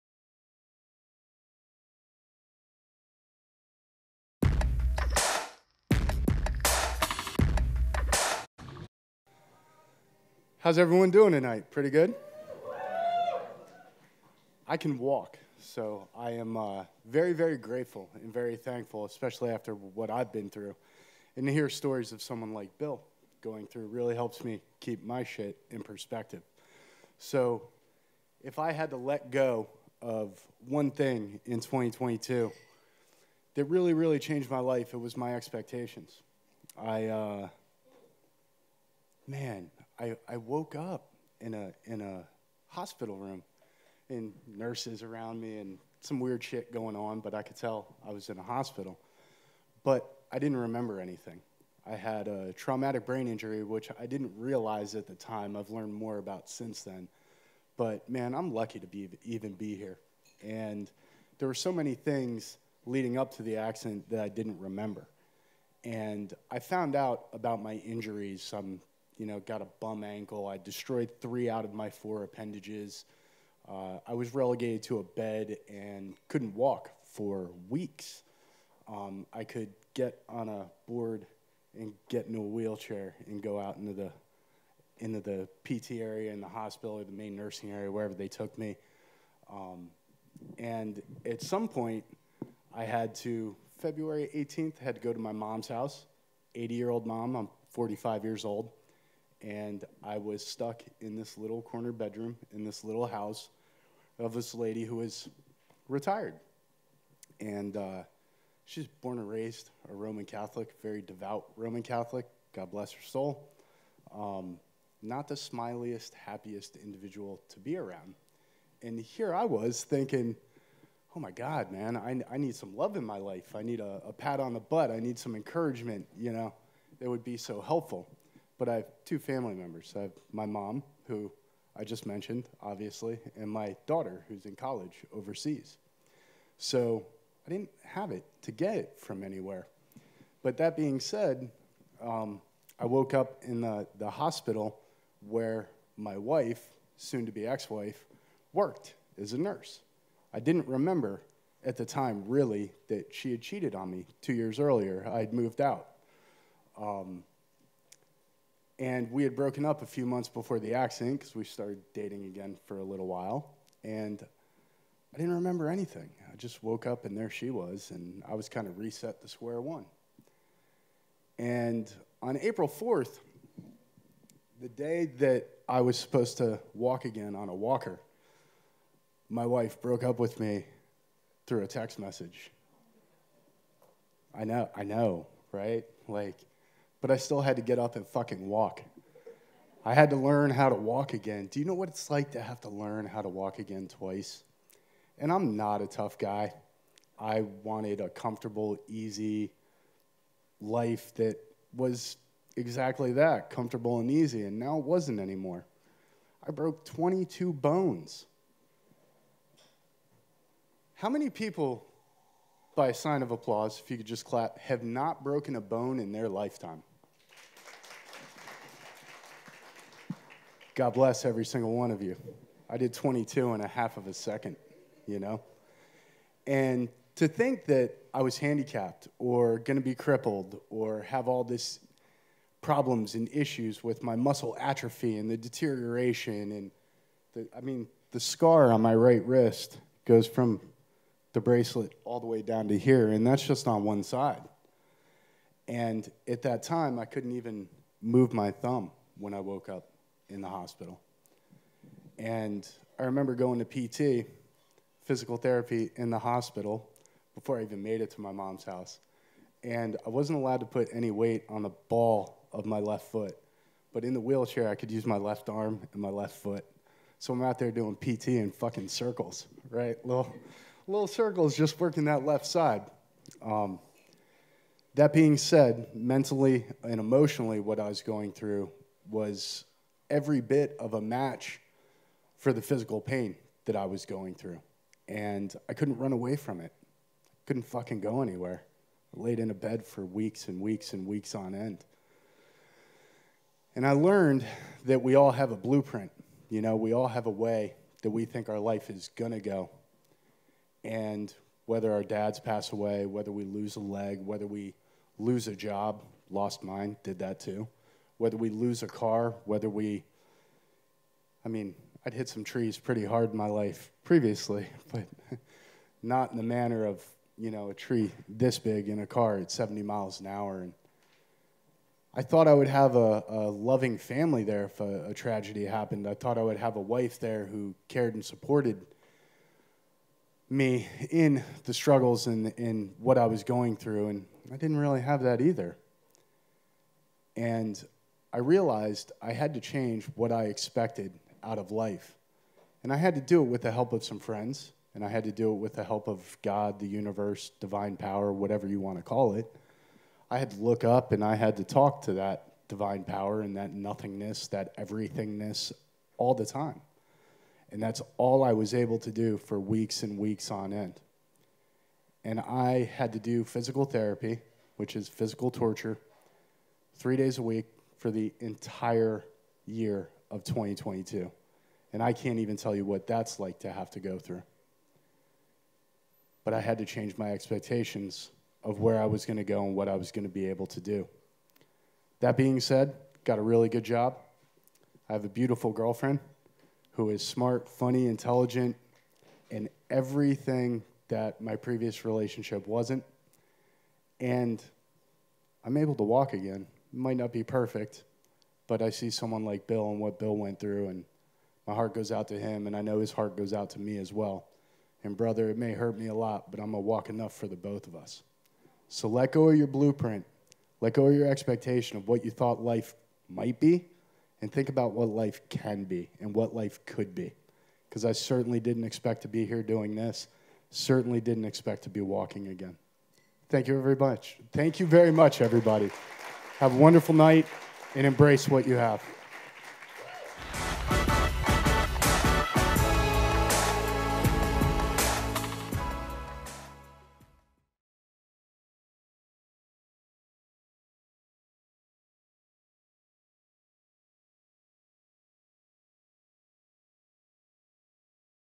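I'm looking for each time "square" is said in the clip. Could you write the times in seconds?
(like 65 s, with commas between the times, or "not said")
169 s.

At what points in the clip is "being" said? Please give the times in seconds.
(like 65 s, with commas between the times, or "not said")
140 s, 275 s, 382 s.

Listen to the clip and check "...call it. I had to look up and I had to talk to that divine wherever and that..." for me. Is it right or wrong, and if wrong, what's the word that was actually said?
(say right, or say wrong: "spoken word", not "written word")
wrong: "power", not "wherever".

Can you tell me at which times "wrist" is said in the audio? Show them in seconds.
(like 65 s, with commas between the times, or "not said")
239 s.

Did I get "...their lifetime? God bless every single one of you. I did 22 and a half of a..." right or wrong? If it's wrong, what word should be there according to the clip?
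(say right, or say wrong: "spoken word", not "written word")
right.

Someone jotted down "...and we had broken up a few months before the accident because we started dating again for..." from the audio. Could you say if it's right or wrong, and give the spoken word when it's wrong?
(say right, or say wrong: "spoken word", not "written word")
right.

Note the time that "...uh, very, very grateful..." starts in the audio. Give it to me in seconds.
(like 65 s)
16 s.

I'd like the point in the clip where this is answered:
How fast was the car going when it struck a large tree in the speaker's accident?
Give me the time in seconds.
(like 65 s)
319 s.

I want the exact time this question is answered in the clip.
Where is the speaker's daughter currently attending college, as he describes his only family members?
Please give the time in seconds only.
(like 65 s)
135 s.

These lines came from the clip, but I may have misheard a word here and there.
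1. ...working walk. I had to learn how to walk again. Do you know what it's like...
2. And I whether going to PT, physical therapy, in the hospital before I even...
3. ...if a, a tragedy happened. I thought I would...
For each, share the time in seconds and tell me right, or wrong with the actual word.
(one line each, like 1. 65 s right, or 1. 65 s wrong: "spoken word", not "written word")
1. 188 s wrong: "fucking", not "working"
2. 252 s wrong: "remember", not "whether"
3. 324 s right.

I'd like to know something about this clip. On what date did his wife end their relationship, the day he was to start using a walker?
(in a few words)
April 4th.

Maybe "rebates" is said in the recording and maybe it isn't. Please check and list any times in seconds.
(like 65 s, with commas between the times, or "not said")
not said.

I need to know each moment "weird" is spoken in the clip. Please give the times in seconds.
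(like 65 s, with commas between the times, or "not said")
46 s.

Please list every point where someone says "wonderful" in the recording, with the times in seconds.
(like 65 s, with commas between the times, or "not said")
426 s.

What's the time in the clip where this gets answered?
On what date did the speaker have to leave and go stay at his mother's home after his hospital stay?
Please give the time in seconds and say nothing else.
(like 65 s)
93 s.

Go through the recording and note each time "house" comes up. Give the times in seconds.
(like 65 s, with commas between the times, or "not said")
95 s, 103 s, 258 s.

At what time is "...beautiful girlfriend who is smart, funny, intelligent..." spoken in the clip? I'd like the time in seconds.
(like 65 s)
385 s.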